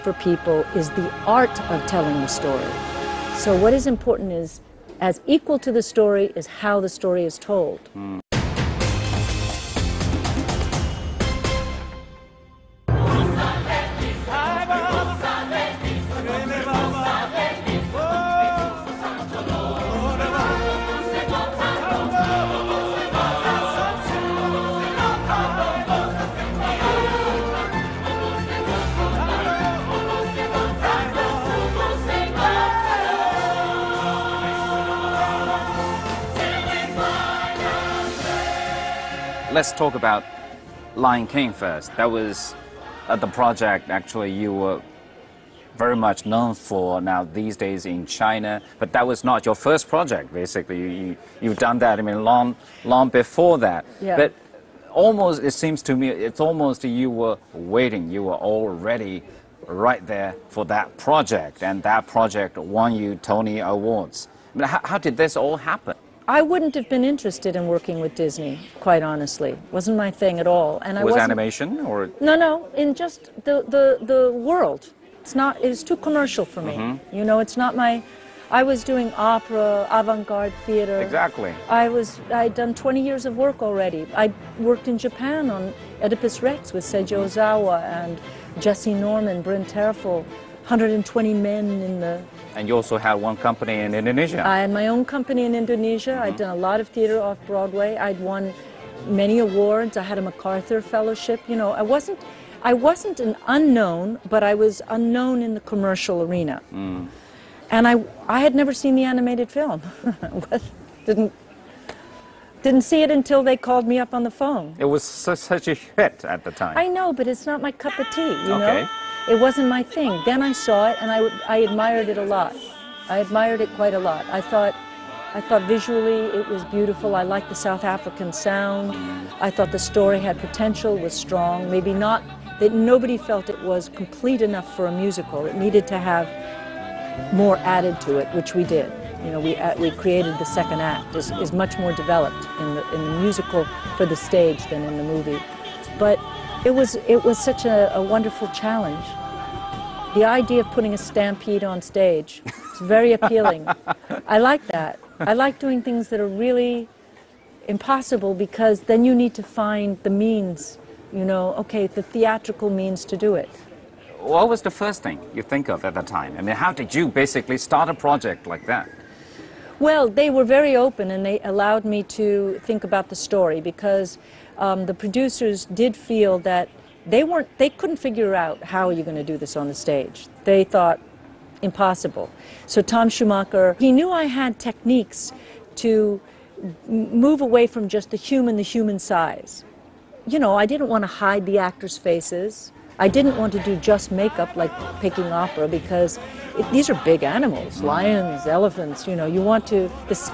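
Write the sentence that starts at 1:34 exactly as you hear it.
I had my own company in Indonesia.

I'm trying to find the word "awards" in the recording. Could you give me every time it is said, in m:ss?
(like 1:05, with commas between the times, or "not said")
1:03, 1:39.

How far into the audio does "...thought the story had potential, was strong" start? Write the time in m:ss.
2:09.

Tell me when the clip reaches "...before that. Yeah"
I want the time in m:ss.
0:53.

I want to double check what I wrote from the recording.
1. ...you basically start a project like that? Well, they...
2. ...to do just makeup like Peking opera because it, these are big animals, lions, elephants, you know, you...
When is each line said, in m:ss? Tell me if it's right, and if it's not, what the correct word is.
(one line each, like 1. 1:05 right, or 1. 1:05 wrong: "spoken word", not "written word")
1. 2:46 right
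2. 3:13 right.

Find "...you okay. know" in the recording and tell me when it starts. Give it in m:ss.
1:58.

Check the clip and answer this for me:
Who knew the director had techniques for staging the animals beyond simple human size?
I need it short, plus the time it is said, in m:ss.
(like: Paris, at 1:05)
Tom Schumacher, at 3:02.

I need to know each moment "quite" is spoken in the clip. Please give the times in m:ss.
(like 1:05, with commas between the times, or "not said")
1:08, 2:03.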